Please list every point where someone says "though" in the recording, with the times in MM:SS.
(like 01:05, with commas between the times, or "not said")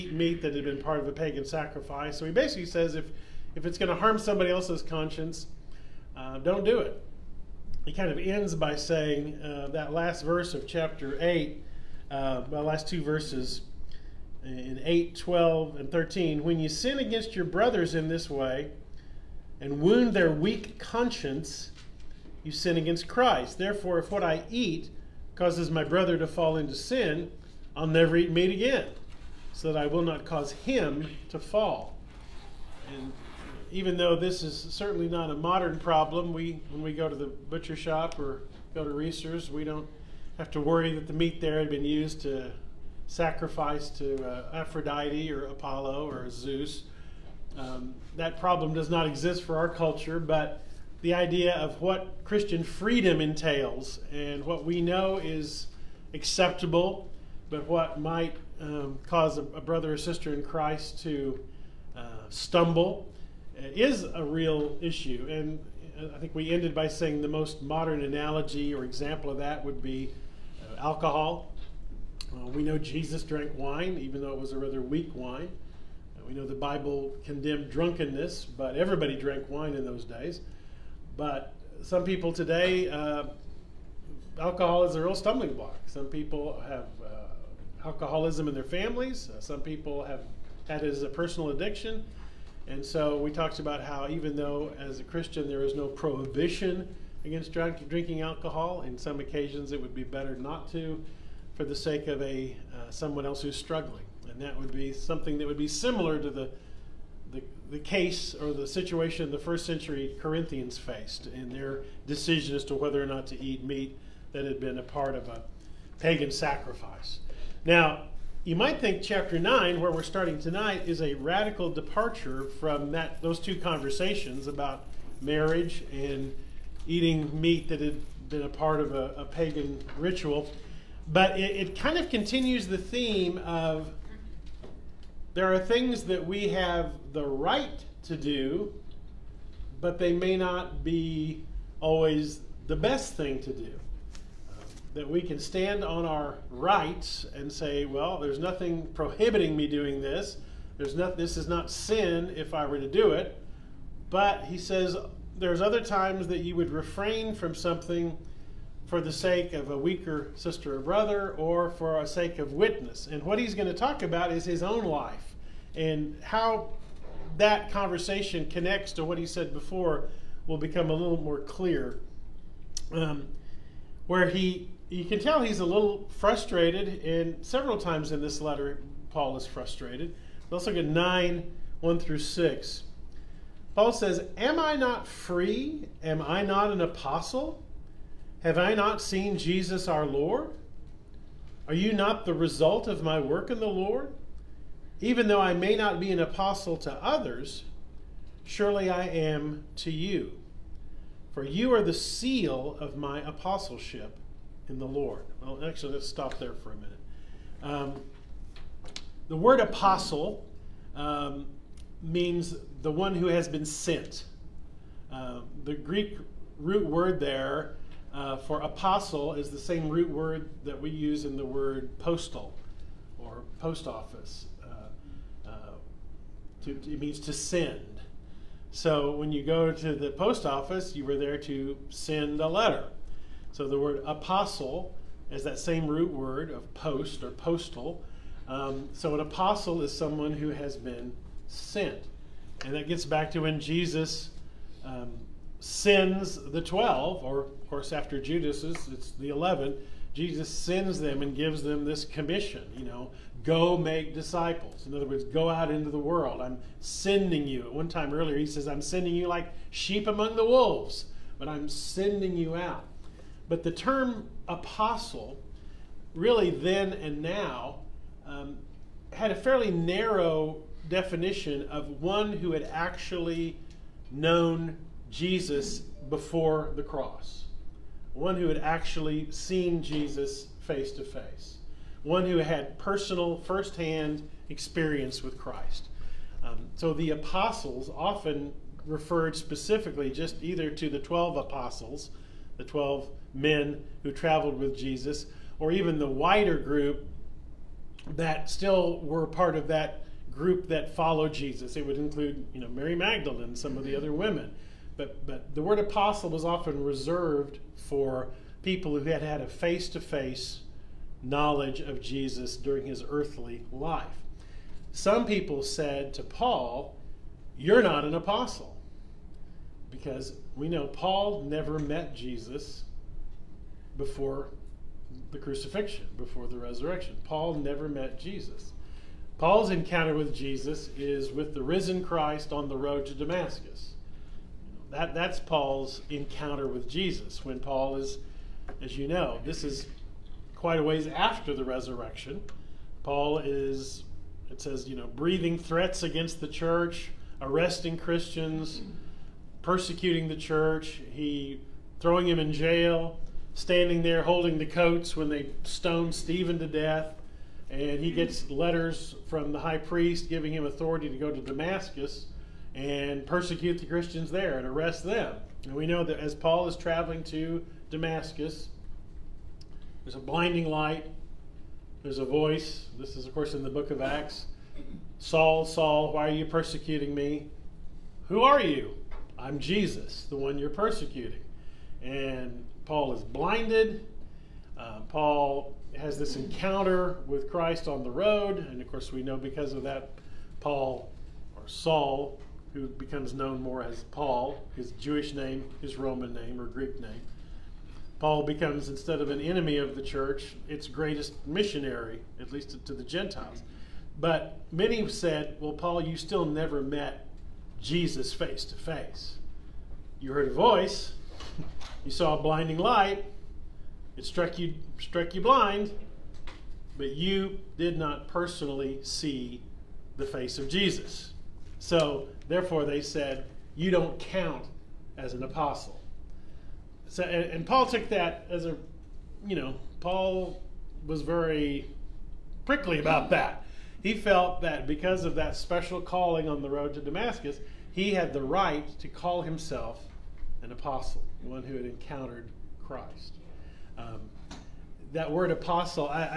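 00:33, 01:14, 01:34, 03:15.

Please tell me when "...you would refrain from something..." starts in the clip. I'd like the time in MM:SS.
02:36.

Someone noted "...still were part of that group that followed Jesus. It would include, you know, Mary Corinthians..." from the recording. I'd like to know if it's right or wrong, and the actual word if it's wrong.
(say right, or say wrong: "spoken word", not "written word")
wrong: "Magdalene", not "Corinthians".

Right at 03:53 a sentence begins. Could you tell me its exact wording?
So the word apostle is that same root word of post or postal.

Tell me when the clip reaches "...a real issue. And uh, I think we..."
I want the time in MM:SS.
01:04.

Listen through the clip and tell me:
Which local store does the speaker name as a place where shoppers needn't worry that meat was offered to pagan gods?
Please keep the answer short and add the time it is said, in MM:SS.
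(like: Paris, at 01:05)
Reasor's, at 00:38.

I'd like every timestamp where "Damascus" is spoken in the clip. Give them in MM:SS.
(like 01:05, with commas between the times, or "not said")
05:33, 06:01, 06:07, 07:17.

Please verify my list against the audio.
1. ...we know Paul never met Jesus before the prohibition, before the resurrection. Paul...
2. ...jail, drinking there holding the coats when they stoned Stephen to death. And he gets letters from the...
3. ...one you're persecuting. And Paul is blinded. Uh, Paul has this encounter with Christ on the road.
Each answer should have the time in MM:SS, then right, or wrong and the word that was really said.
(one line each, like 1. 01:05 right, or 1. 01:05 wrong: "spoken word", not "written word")
1. 05:20 wrong: "crucifixion", not "prohibition"
2. 05:52 wrong: "standing", not "drinking"
3. 06:20 right.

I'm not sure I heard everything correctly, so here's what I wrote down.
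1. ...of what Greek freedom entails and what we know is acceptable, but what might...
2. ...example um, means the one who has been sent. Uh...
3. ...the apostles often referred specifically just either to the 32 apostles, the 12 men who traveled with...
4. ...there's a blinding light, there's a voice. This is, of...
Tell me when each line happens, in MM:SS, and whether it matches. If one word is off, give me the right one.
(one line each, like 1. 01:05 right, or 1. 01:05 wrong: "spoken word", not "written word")
1. 00:51 wrong: "Christian", not "Greek"
2. 03:29 wrong: "apostle", not "example"
3. 04:46 wrong: "12", not "32"
4. 06:10 right.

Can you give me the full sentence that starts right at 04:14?
In other words, go out into the world.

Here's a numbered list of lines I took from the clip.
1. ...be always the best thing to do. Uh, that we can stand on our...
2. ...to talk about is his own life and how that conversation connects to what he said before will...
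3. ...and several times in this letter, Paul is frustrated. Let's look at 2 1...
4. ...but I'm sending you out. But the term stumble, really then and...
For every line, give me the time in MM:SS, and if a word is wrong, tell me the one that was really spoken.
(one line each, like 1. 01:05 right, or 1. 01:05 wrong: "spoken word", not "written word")
1. 02:20 right
2. 02:43 right
3. 02:57 wrong: "9", not "2"
4. 04:21 wrong: "apostle", not "stumble".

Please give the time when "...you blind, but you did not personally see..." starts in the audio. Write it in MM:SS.
06:55.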